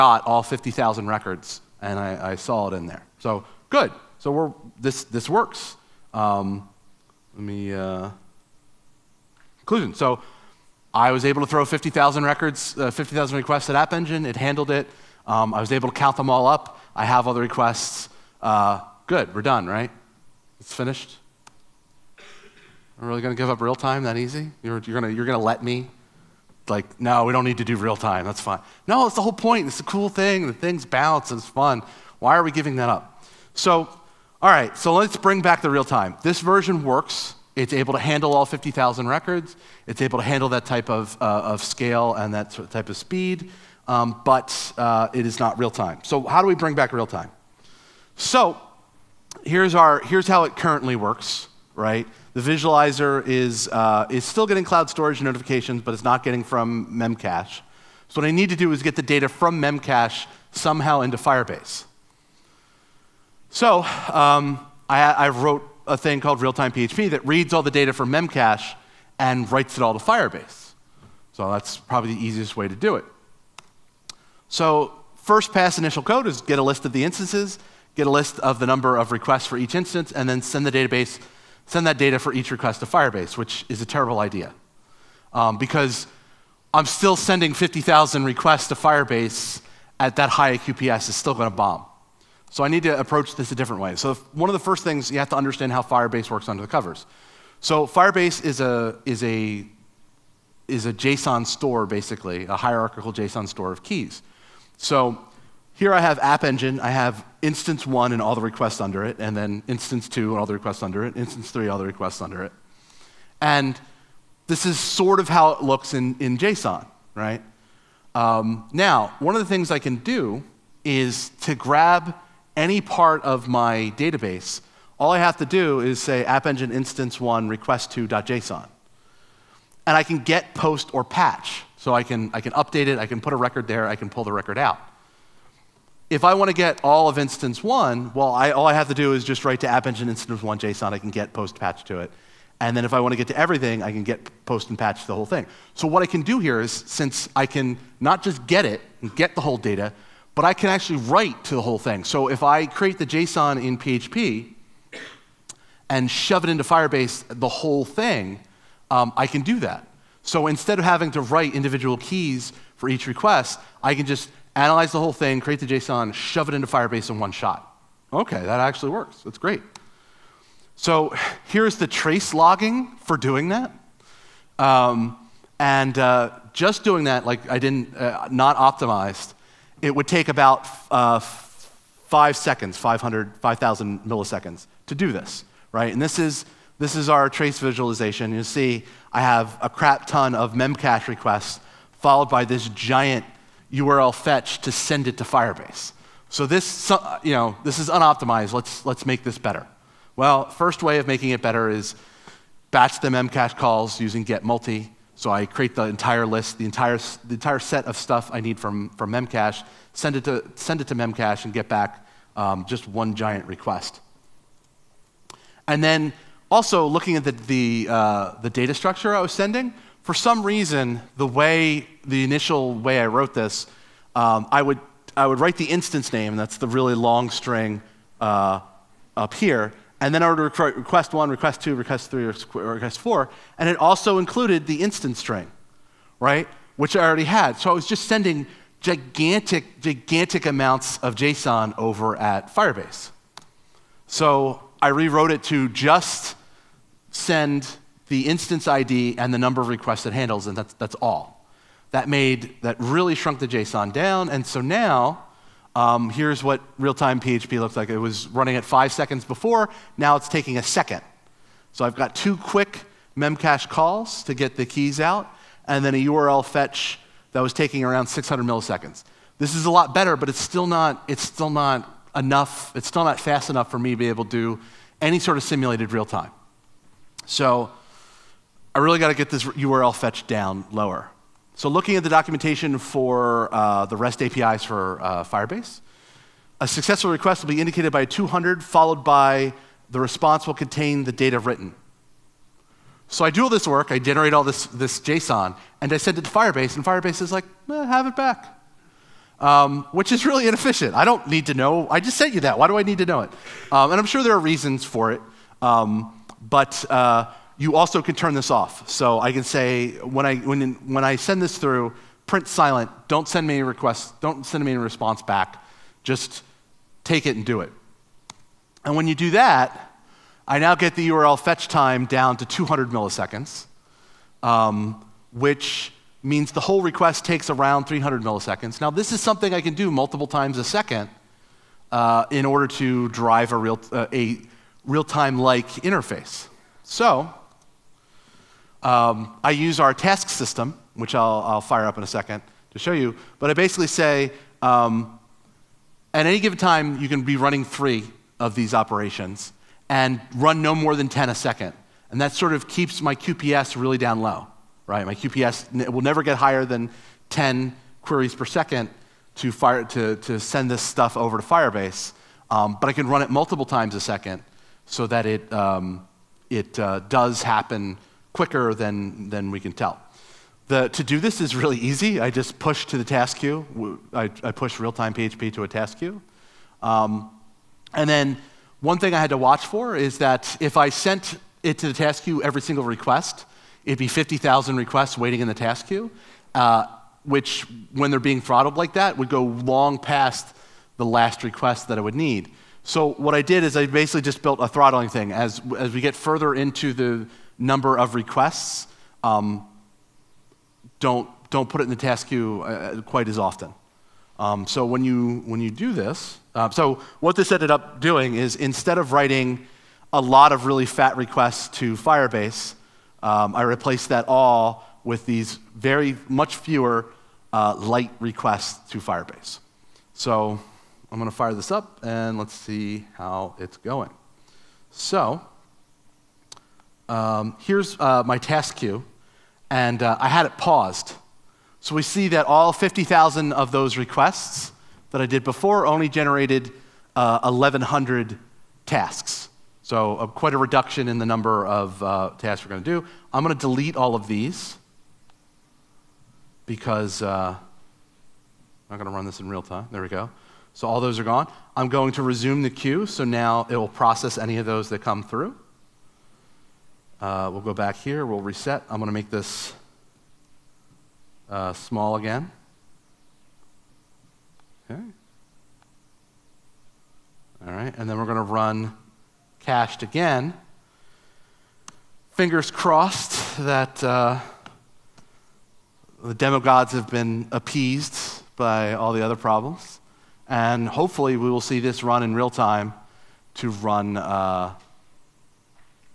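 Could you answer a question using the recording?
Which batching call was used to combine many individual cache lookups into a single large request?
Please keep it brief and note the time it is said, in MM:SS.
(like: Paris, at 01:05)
get multi, at 03:24.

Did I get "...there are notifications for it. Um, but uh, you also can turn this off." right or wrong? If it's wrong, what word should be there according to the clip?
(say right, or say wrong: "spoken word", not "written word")
wrong: "reasons", not "notifications".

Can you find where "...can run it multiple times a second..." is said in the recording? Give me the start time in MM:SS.
06:02.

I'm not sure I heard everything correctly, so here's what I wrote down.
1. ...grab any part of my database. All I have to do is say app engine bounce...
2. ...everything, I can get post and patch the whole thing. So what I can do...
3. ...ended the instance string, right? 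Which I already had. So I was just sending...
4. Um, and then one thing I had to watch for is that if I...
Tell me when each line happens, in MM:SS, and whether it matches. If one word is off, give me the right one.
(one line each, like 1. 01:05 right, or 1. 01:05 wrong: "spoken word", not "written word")
1. 02:01 wrong: "instance", not "bounce"
2. 02:23 right
3. 03:54 wrong: "included", not "ended"
4. 06:16 right.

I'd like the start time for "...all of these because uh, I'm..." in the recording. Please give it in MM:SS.
07:23.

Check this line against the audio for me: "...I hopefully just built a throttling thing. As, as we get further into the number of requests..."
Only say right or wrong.
wrong.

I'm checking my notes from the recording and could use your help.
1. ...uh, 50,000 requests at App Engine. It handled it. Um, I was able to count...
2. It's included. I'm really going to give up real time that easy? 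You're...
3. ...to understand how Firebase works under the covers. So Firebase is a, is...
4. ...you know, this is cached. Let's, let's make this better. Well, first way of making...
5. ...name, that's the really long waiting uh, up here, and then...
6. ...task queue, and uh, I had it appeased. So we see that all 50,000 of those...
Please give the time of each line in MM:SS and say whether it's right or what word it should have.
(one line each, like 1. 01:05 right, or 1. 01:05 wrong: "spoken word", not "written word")
1. 00:12 right
2. 00:20 wrong: "finished", not "included"
3. 01:35 right
4. 03:17 wrong: "unoptimized", not "cached"
5. 03:46 wrong: "string", not "waiting"
6. 07:08 wrong: "paused", not "appeased".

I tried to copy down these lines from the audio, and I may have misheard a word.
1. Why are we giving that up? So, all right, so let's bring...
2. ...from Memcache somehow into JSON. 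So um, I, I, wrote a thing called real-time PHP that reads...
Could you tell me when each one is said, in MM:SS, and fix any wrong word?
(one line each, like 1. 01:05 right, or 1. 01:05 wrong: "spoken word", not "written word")
1. 00:32 right
2. 00:59 wrong: "Firebase", not "JSON".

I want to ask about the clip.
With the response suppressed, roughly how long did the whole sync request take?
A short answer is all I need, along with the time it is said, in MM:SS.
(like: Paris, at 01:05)
300 milliseconds, at 05:27.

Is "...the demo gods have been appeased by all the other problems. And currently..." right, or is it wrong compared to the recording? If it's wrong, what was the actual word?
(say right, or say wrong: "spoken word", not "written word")
wrong: "hopefully", not "currently".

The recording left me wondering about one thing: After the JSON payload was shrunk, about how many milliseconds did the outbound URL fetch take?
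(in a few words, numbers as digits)
600 milliseconds.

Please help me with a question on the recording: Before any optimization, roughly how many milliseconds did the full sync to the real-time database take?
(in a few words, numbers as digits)
5,000 milliseconds.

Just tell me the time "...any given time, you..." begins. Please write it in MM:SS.
05:46.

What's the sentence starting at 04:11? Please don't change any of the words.
That made, that really shrunk the JSON down, and so now, um, here's what real-time PHP looks like.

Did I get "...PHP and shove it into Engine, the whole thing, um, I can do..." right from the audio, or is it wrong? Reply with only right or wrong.
wrong.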